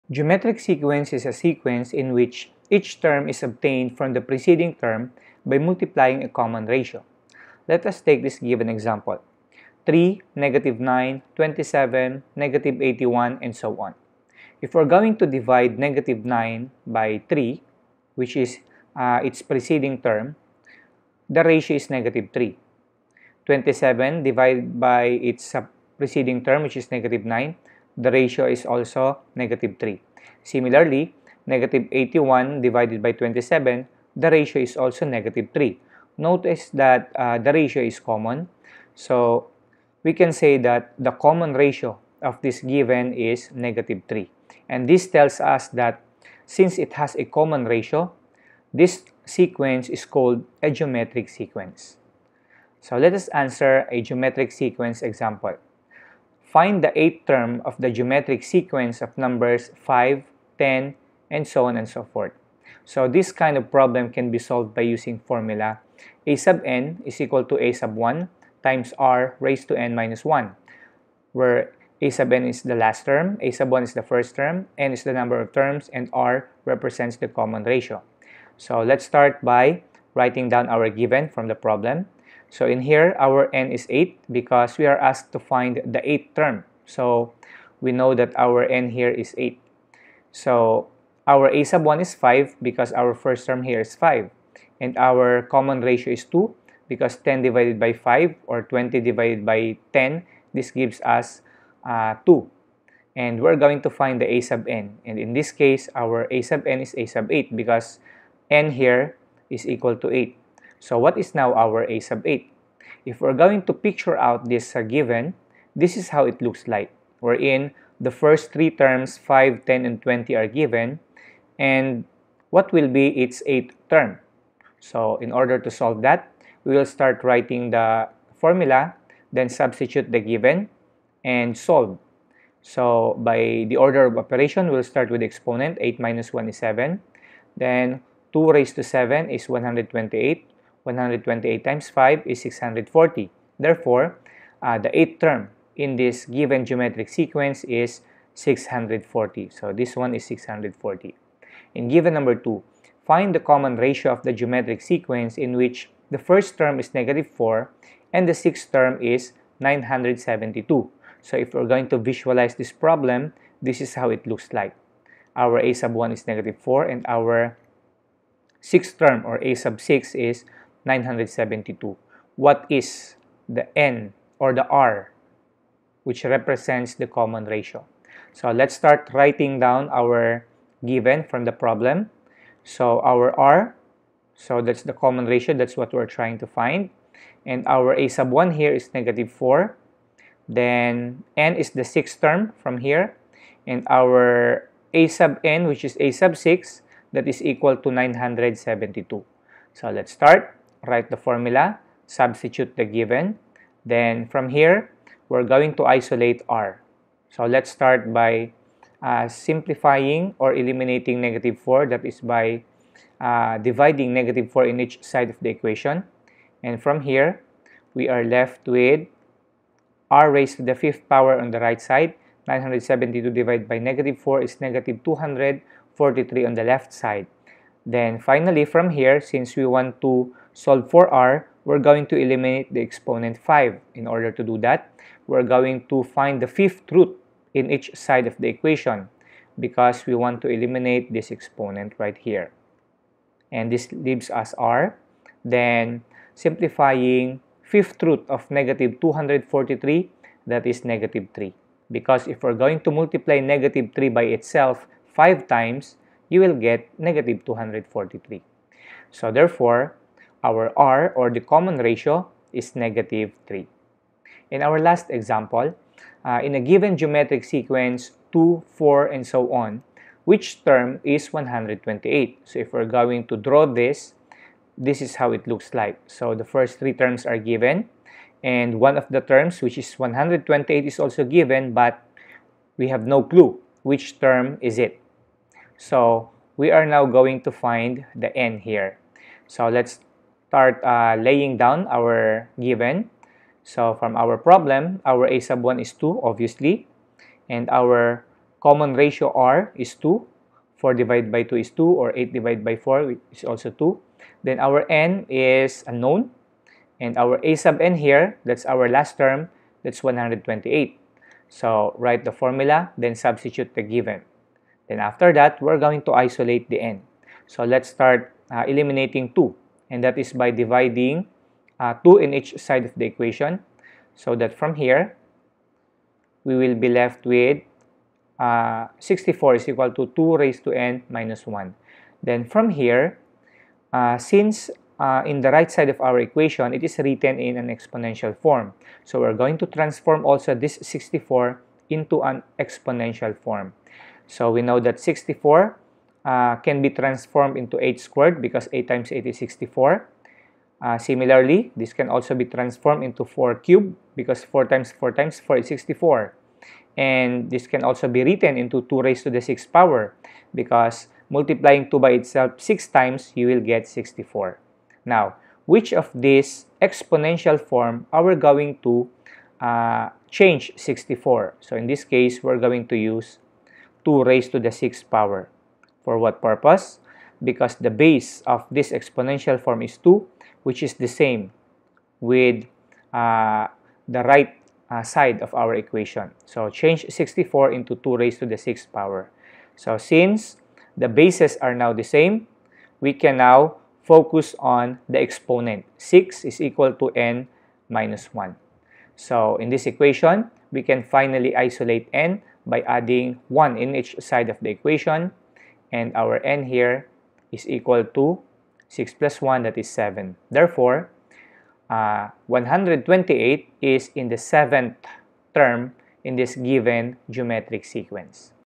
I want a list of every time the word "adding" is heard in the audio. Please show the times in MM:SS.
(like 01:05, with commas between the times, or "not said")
06:42.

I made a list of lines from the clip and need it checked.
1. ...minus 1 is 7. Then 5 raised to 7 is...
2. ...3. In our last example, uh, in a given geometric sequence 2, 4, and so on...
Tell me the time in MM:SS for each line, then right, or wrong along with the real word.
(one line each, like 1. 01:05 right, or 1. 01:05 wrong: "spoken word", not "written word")
1. 02:16 wrong: "2", not "5"
2. 04:23 right.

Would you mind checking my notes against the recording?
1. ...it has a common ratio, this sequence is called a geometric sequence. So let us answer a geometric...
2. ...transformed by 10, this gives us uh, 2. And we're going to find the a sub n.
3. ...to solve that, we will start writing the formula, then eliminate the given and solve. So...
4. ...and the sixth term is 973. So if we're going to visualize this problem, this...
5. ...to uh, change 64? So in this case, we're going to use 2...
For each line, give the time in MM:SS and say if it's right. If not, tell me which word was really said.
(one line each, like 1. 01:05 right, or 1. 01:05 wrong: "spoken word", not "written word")
1. 00:46 right
2. 01:38 wrong: "divided", not "transformed"
3. 02:05 wrong: "substitute", not "eliminate"
4. 02:38 wrong: "972", not "973"
5. 06:08 right.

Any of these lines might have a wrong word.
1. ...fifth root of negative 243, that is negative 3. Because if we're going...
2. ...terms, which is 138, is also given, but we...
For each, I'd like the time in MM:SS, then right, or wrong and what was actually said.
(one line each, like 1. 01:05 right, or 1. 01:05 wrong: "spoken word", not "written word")
1. 04:07 right
2. 04:39 wrong: "128", not "138".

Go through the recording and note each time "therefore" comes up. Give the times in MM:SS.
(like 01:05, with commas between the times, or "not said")
02:23, 04:19, 06:50.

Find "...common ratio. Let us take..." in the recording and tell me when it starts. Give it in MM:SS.
00:06.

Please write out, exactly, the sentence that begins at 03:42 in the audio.
972 divided by negative 4 is negative 243 on the left side.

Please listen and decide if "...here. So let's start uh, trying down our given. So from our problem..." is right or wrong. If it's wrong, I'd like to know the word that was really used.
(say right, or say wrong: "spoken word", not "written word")
wrong: "laying", not "trying".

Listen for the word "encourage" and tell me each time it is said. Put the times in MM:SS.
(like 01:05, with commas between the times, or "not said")
not said.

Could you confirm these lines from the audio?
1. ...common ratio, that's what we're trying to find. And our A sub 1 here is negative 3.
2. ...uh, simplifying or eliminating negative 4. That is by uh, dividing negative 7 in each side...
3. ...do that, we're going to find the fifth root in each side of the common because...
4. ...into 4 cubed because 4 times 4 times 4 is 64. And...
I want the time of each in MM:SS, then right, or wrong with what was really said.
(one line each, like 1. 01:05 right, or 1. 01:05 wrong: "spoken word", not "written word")
1. 03:04 wrong: "4", not "3"
2. 03:29 wrong: "4", not "7"
3. 03:54 wrong: "equation", not "common"
4. 05:53 right.